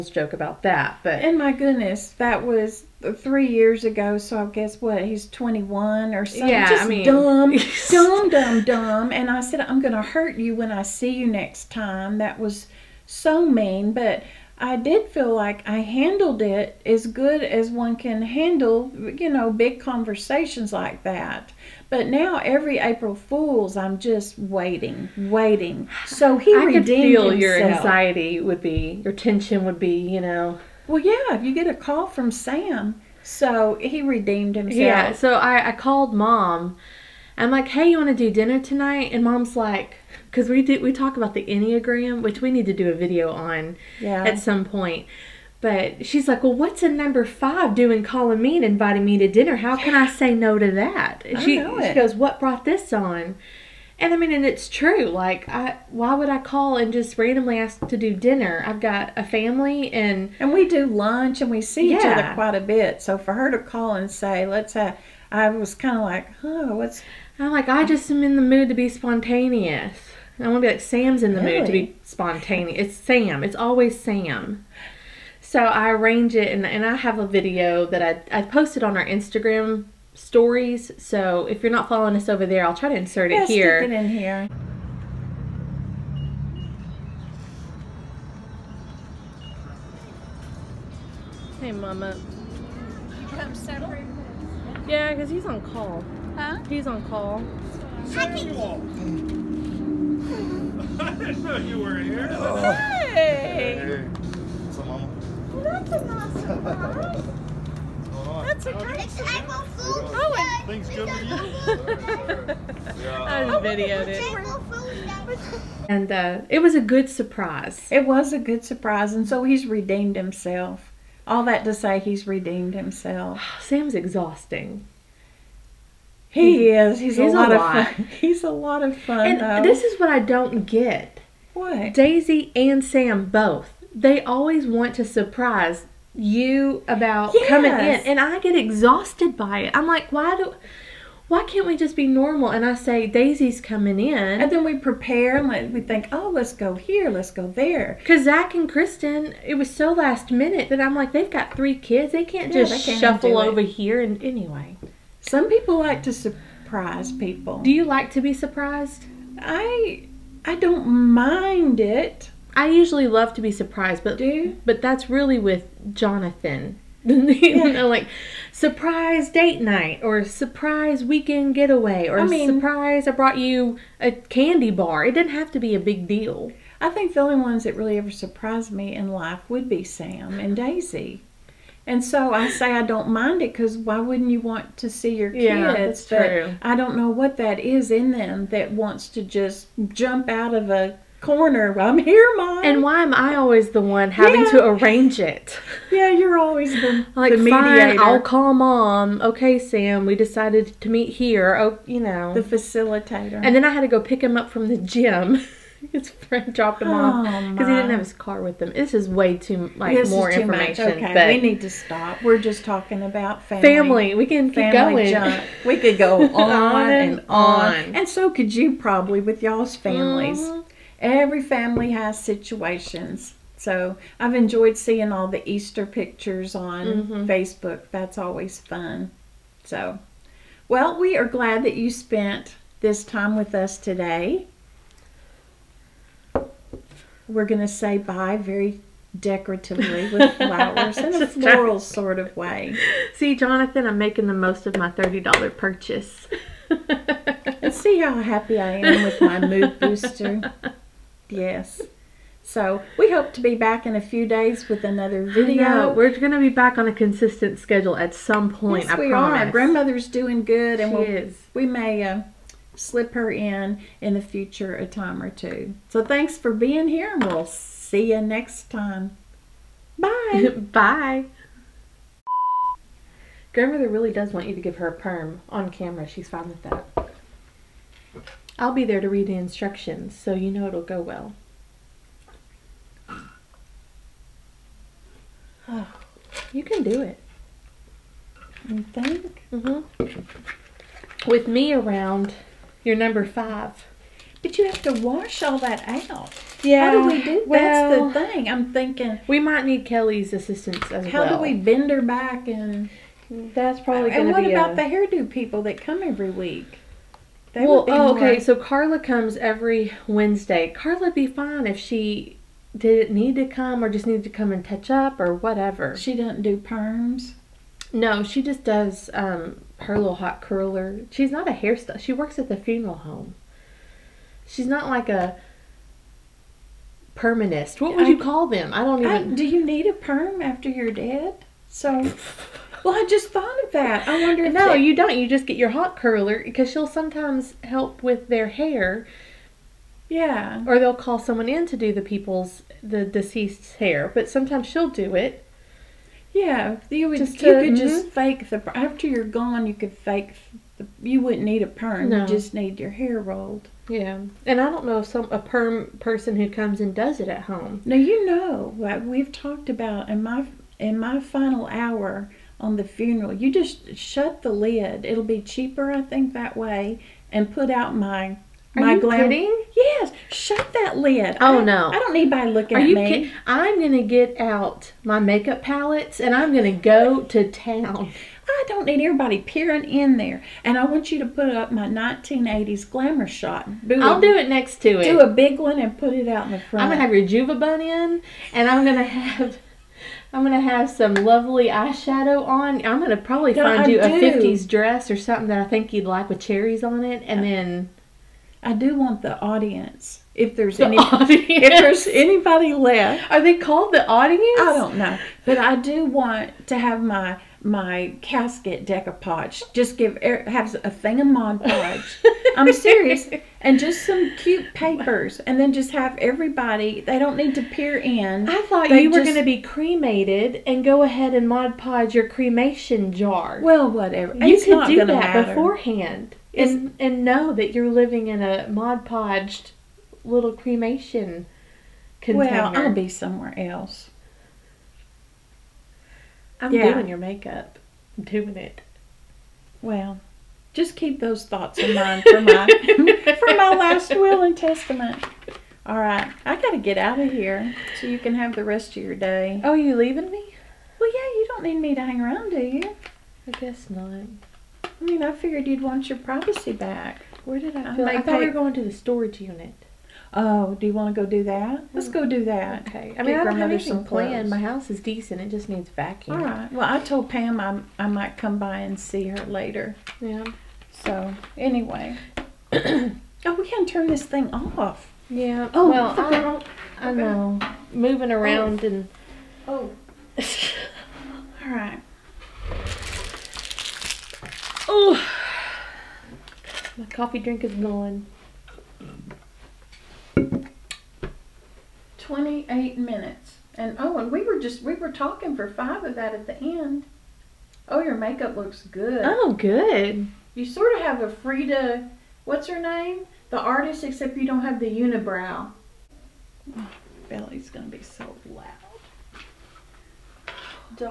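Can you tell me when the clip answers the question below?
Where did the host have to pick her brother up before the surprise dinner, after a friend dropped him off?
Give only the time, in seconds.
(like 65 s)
204 s.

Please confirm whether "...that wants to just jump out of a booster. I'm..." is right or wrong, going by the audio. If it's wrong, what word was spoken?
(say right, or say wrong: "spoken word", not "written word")
wrong: "corner", not "booster".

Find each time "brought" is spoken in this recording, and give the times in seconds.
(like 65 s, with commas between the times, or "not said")
52 s, 173 s.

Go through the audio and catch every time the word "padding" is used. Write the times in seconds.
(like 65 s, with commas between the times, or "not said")
not said.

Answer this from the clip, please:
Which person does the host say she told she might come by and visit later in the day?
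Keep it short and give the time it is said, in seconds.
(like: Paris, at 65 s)
Pam, at 467 s.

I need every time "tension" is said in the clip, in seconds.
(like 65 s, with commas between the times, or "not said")
29 s.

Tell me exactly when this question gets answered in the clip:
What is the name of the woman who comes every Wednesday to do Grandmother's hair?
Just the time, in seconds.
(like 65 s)
308 s.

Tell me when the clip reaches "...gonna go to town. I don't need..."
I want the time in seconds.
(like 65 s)
376 s.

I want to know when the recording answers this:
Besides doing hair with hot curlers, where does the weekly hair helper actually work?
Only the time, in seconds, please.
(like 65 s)
322 s.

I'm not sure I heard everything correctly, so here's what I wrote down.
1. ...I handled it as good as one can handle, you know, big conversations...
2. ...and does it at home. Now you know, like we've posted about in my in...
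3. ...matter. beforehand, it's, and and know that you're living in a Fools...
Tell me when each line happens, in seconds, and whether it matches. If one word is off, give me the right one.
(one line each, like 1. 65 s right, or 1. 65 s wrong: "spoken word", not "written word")
1. 15 s right
2. 356 s wrong: "talked", not "posted"
3. 425 s wrong: "Mod", not "Fools".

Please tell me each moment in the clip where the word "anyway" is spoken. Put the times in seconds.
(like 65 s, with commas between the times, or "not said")
154 s, 471 s.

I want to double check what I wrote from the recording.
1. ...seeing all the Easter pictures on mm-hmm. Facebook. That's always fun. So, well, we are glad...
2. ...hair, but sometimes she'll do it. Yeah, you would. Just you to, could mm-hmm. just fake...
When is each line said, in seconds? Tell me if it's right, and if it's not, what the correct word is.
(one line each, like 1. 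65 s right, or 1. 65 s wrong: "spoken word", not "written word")
1. 224 s right
2. 343 s right.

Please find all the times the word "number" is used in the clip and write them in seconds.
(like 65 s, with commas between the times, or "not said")
46 s, 292 s.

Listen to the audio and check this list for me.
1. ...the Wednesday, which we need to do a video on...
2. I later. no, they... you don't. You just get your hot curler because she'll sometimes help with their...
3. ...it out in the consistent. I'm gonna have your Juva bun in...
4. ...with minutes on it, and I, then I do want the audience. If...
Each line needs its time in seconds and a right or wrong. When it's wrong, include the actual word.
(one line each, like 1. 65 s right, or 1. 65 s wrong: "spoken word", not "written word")
1. 41 s wrong: "Enneagram", not "Wednesday"
2. 334 s wrong: "wonder", not "later"
3. 386 s wrong: "front", not "consistent"
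4. 396 s wrong: "cherries", not "minutes".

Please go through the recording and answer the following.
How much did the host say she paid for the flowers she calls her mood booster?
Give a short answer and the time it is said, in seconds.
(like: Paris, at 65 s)
$30, at 244 s.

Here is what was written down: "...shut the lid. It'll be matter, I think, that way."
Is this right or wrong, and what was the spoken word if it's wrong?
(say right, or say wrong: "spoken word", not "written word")
wrong: "cheaper", not "matter".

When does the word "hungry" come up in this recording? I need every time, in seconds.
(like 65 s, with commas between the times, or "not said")
not said.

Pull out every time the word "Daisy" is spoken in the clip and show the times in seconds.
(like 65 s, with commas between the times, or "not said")
131 s, 143 s, 180 s.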